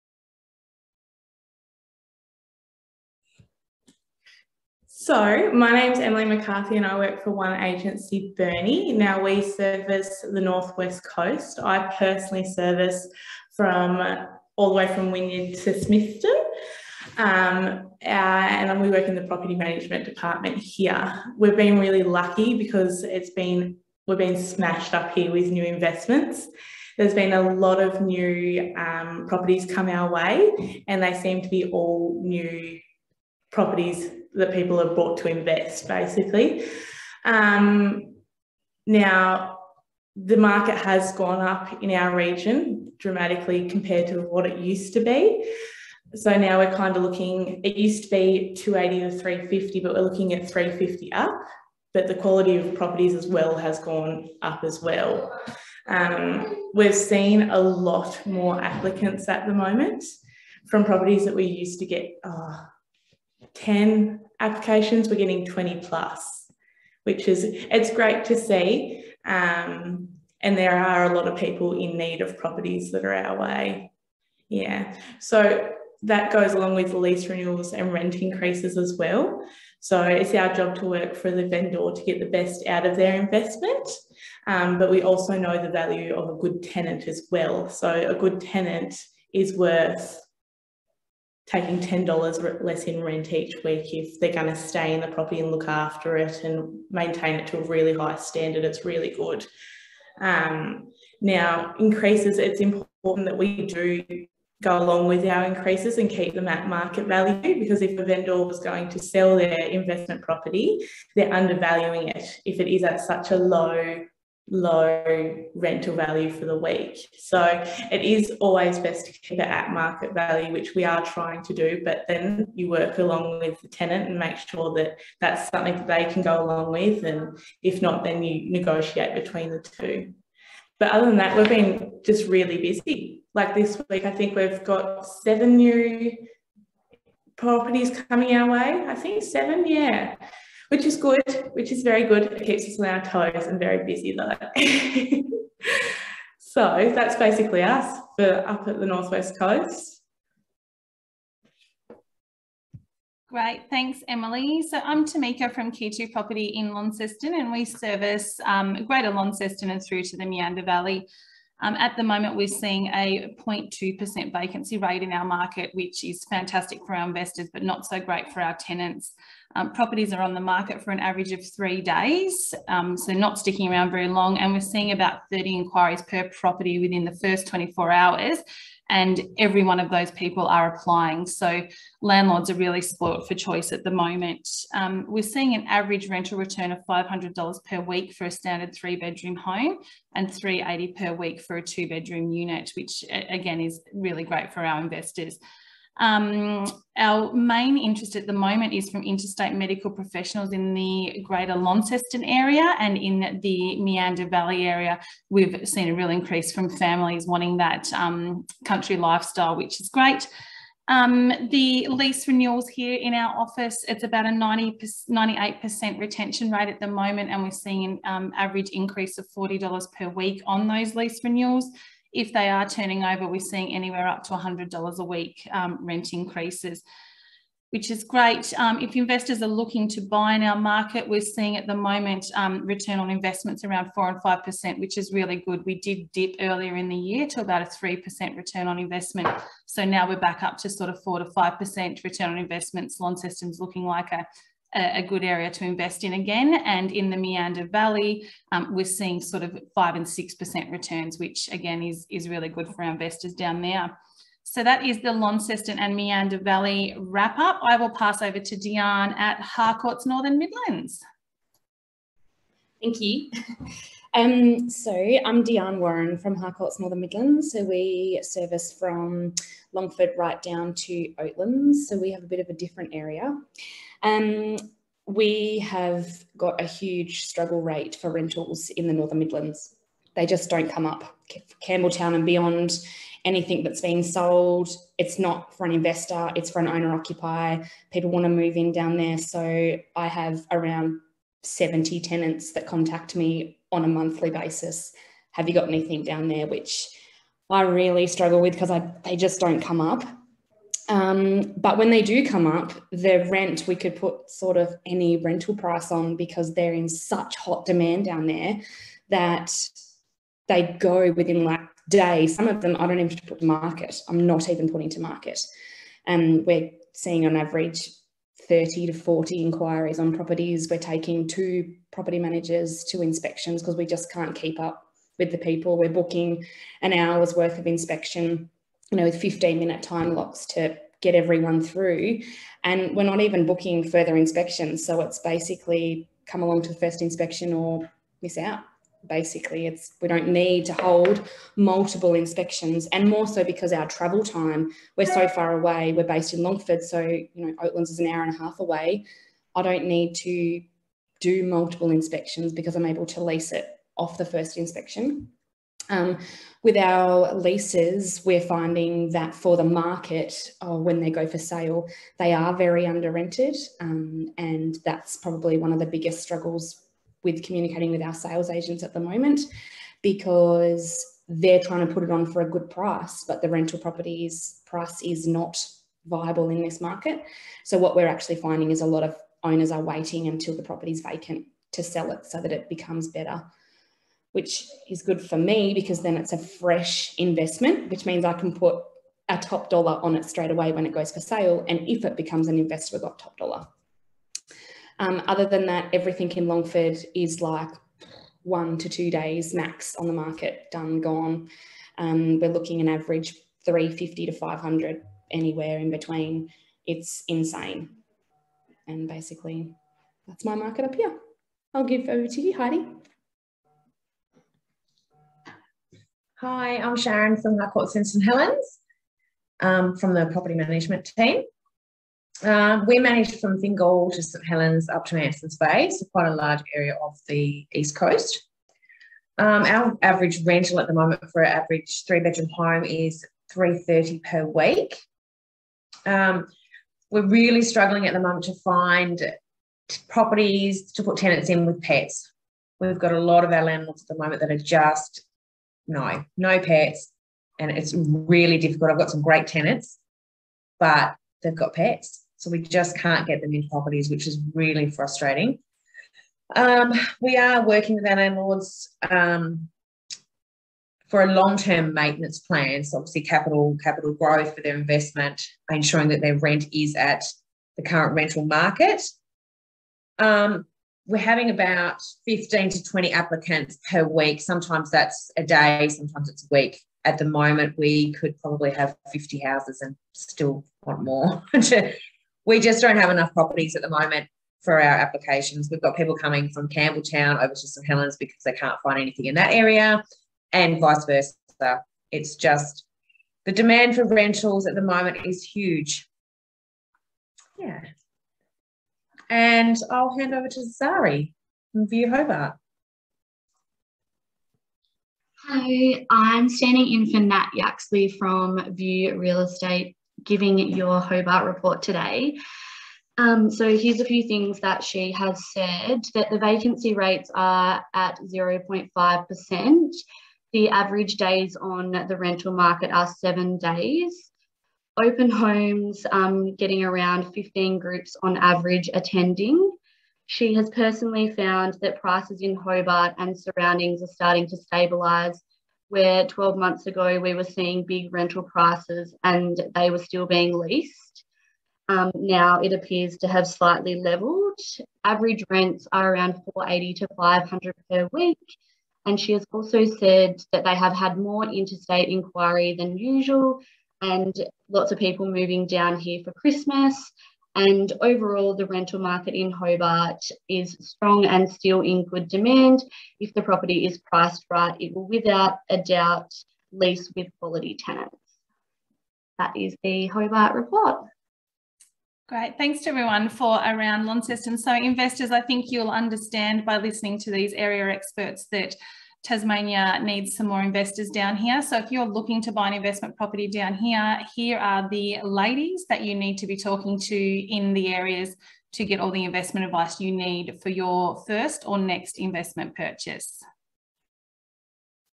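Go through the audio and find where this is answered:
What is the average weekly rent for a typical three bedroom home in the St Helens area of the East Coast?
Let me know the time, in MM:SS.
07:13.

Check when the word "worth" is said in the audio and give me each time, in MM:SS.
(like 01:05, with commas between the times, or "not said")
01:29, 05:27.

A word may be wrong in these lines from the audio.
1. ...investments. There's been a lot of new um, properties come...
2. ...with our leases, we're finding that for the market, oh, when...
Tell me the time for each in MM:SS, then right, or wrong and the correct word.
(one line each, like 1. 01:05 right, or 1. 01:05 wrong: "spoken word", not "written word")
1. 00:25 right
2. 05:56 right.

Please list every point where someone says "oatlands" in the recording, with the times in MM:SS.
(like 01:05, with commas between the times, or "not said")
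04:31, 05:47.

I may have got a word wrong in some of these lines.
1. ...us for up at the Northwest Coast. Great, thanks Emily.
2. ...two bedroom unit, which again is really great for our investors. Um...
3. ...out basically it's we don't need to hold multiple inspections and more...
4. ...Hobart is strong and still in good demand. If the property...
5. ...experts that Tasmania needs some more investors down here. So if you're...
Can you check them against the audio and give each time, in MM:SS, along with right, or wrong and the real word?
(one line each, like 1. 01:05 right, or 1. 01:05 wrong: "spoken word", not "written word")
1. 02:27 right
2. 03:11 right
3. 05:38 right
4. 09:19 right
5. 09:37 right.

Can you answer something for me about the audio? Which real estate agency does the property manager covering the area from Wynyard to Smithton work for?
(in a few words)
One Agency Burnie.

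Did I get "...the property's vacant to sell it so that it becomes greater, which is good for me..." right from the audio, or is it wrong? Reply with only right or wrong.
wrong.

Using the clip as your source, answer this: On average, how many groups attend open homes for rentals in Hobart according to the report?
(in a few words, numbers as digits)
15.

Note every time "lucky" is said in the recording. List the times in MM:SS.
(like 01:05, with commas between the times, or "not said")
00:22.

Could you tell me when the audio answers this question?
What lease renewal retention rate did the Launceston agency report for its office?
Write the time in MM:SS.
03:35.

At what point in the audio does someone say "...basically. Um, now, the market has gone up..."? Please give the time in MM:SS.
00:35.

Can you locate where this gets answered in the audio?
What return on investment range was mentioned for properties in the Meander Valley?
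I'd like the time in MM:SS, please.
04:09.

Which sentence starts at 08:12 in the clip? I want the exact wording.
It's just the demand for rentals at the moment is huge.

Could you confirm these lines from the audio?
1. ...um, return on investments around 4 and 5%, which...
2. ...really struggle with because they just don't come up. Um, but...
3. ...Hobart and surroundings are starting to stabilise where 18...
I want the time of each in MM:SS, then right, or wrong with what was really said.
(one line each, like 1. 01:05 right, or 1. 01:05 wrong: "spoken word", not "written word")
1. 03:52 right
2. 04:57 right
3. 08:52 wrong: "12", not "18".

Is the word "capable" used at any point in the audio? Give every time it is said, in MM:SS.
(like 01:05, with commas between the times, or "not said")
not said.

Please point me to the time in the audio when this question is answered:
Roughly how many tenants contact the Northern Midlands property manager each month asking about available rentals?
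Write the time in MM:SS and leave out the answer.
04:51.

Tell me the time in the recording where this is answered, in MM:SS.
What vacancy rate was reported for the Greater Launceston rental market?
02:43.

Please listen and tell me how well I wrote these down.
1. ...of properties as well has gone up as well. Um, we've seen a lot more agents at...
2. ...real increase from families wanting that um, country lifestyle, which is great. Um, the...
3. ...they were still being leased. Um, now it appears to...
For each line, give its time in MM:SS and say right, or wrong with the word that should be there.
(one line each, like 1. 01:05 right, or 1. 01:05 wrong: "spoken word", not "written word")
1. 00:52 wrong: "applicants", not "agents"
2. 03:25 right
3. 08:59 right.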